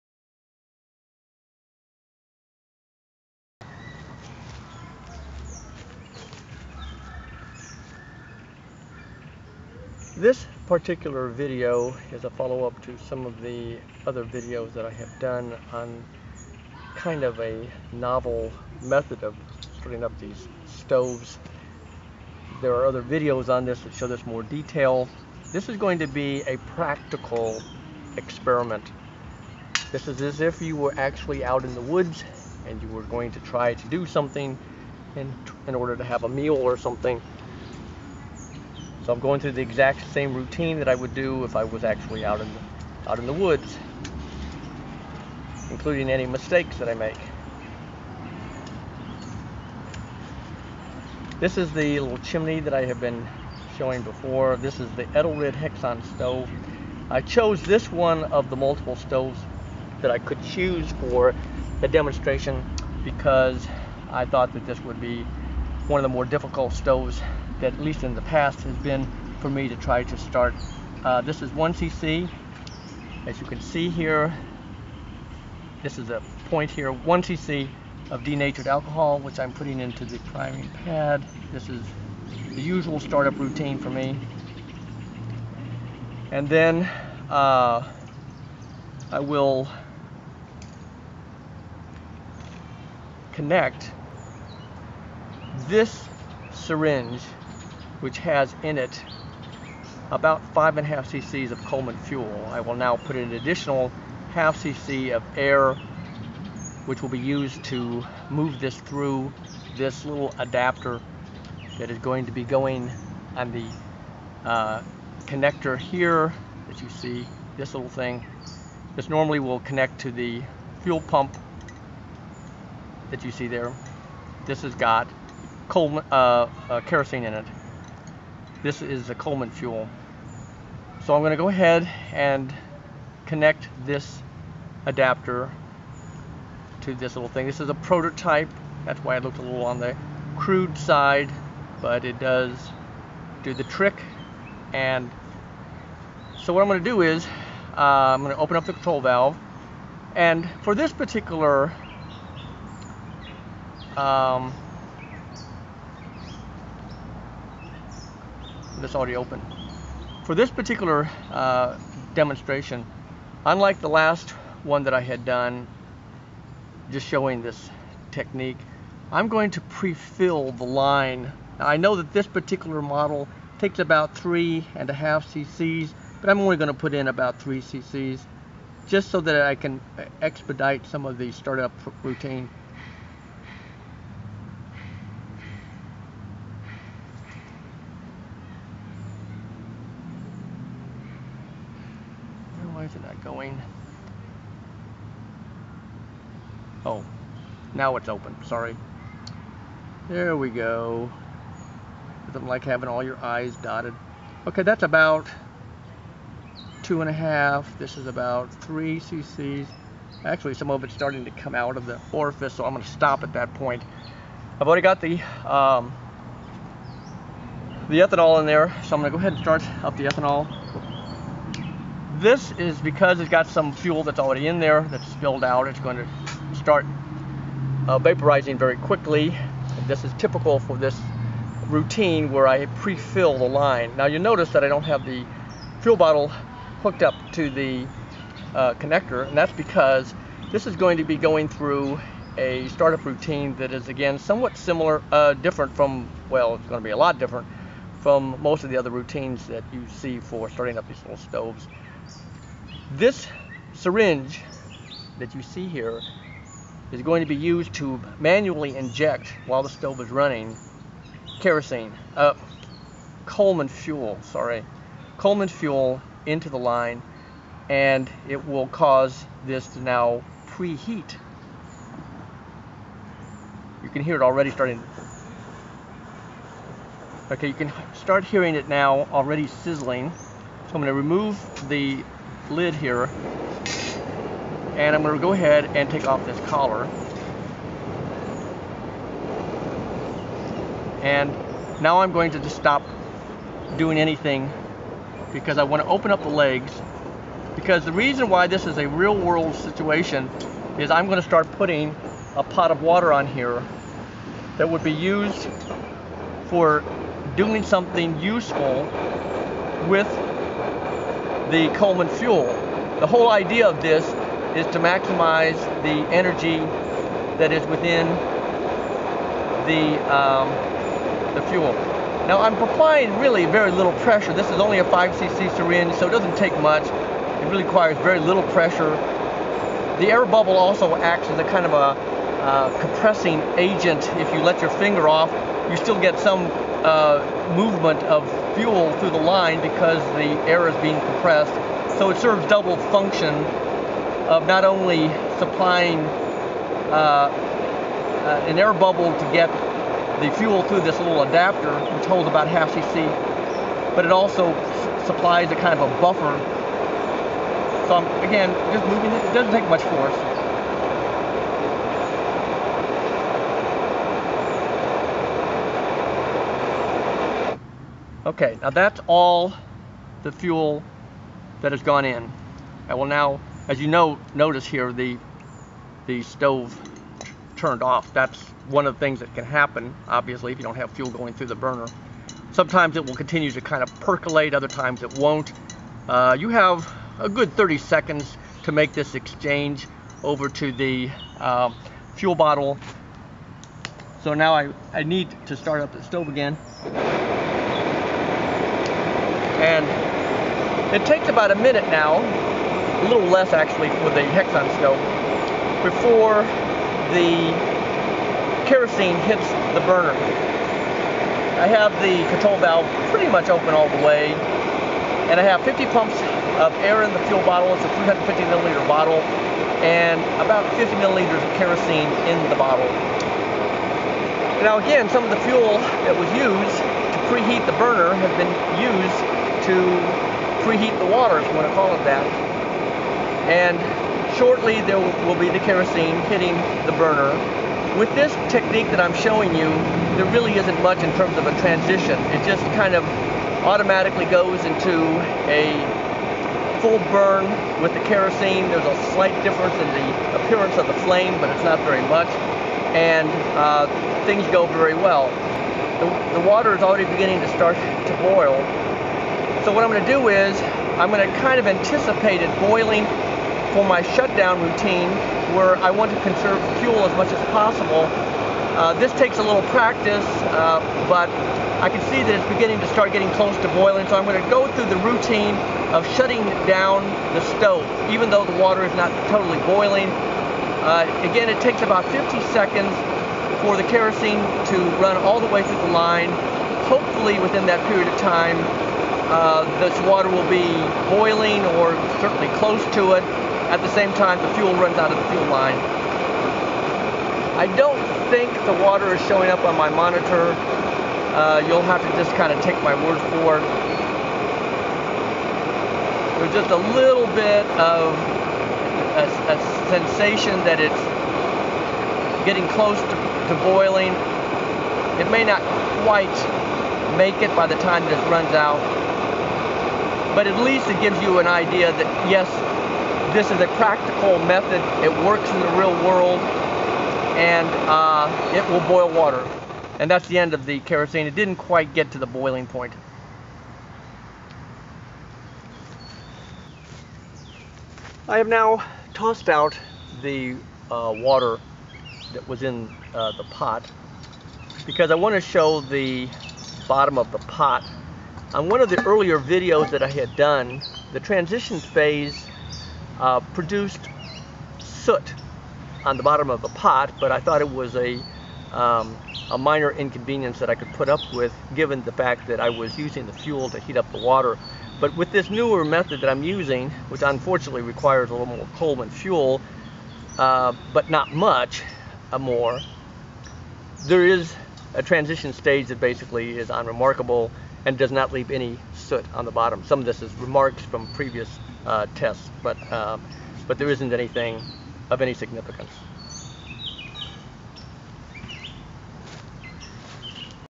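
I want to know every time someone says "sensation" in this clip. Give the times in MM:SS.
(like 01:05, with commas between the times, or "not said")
08:29.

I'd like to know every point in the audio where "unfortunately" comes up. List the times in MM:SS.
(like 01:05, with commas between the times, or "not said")
09:27.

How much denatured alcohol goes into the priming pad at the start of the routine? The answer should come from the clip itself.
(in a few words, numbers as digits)
1cc.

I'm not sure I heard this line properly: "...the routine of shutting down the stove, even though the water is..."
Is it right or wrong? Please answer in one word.
right.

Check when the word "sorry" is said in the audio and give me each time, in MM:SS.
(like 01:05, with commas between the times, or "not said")
03:18, 04:24.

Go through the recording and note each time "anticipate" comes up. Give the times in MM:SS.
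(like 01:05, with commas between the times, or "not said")
07:41.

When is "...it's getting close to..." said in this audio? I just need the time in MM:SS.
08:30.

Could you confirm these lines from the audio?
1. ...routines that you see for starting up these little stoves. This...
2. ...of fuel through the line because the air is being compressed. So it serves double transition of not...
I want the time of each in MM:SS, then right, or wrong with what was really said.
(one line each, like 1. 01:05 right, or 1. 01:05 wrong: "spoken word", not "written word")
1. 04:08 right
2. 05:38 wrong: "function", not "transition".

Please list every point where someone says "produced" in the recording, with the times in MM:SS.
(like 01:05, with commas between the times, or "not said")
09:13.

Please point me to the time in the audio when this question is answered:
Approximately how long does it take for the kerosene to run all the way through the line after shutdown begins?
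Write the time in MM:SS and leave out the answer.
08:02.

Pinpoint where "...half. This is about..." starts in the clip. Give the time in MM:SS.
03:27.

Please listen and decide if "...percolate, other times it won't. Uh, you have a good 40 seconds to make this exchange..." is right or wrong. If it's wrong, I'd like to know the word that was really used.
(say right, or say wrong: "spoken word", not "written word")
wrong: "30", not "40".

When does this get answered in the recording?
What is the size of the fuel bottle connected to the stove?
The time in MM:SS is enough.
06:58.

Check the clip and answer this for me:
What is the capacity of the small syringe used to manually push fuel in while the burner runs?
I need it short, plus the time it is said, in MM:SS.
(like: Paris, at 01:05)
5cc, at 05:24.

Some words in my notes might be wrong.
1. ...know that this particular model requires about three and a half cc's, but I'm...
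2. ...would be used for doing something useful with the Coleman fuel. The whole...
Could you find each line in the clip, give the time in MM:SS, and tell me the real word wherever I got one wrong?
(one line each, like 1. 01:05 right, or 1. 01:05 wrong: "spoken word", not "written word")
1. 02:51 wrong: "takes", not "requires"
2. 05:04 right.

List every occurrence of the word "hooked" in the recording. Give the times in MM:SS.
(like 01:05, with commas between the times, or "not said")
03:56.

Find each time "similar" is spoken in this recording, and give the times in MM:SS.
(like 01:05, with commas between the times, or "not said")
04:04.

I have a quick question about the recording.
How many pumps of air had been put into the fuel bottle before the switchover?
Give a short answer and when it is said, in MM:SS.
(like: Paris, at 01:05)
50, at 06:55.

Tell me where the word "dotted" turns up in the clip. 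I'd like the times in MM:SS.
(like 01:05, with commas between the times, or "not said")
03:23.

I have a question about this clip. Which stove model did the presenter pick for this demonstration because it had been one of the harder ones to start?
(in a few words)
Edelrid Hexon.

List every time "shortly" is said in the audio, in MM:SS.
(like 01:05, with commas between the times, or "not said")
07:14.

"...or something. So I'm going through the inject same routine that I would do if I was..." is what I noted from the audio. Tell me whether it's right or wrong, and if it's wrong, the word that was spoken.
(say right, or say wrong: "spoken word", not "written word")
wrong: "exact", not "inject".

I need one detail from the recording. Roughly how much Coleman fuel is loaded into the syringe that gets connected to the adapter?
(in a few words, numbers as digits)
5.5 cc.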